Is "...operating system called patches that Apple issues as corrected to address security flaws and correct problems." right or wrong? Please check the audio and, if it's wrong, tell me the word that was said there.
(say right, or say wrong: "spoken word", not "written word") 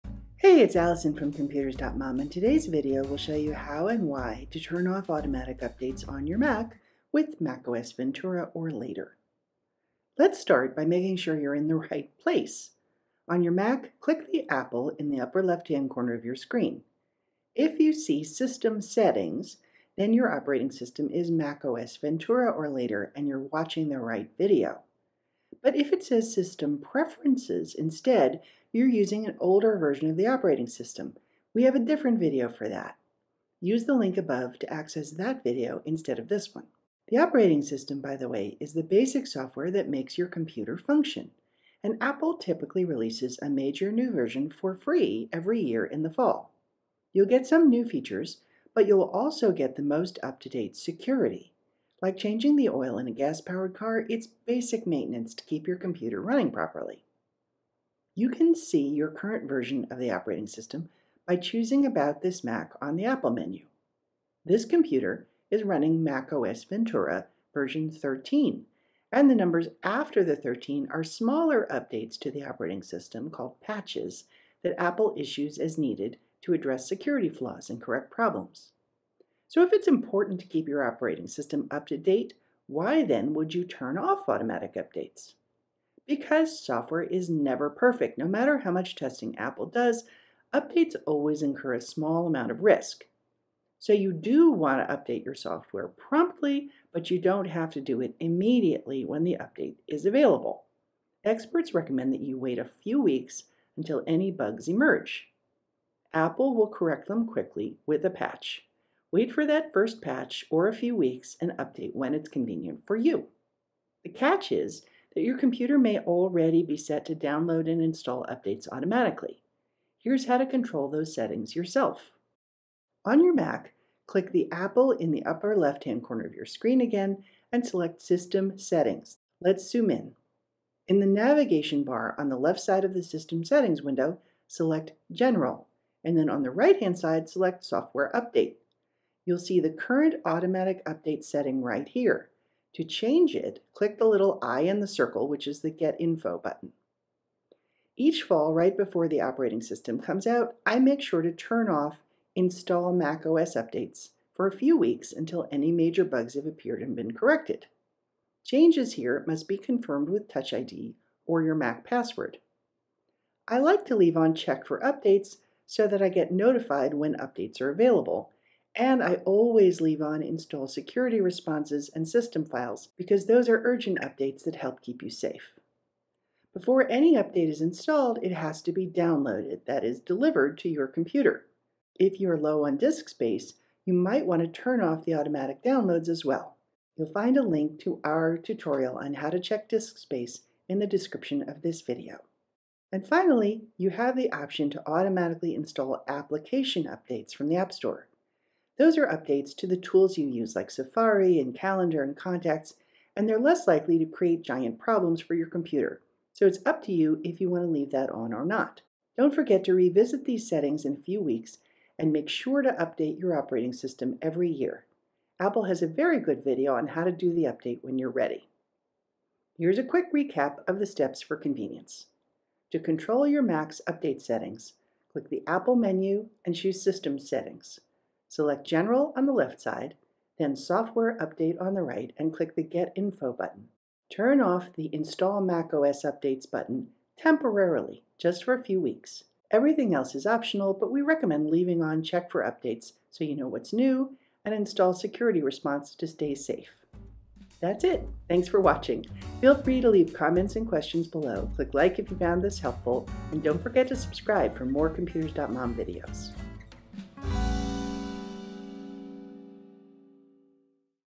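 wrong: "needed", not "corrected".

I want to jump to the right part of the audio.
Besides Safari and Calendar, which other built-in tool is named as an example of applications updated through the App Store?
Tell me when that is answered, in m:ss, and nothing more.
3:22.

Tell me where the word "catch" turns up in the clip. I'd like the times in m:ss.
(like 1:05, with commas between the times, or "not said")
1:54.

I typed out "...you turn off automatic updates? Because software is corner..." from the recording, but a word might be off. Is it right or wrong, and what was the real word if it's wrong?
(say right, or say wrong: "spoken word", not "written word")
wrong: "never", not "corner".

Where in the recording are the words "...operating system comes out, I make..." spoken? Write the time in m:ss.
2:29.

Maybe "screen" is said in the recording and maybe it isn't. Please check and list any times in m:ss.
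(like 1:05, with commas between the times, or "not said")
0:16, 2:06.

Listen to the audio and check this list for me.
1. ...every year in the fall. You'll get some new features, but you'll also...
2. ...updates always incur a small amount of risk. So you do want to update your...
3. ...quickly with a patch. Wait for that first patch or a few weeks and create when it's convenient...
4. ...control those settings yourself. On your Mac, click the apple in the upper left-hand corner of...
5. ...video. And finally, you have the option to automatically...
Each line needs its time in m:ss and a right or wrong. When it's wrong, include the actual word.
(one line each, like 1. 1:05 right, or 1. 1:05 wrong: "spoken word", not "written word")
1. 0:45 right
2. 1:30 right
3. 1:47 wrong: "update", not "create"
4. 2:00 right
5. 3:11 right.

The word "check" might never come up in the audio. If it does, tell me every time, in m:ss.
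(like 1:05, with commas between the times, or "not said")
2:44, 3:09, 4:02.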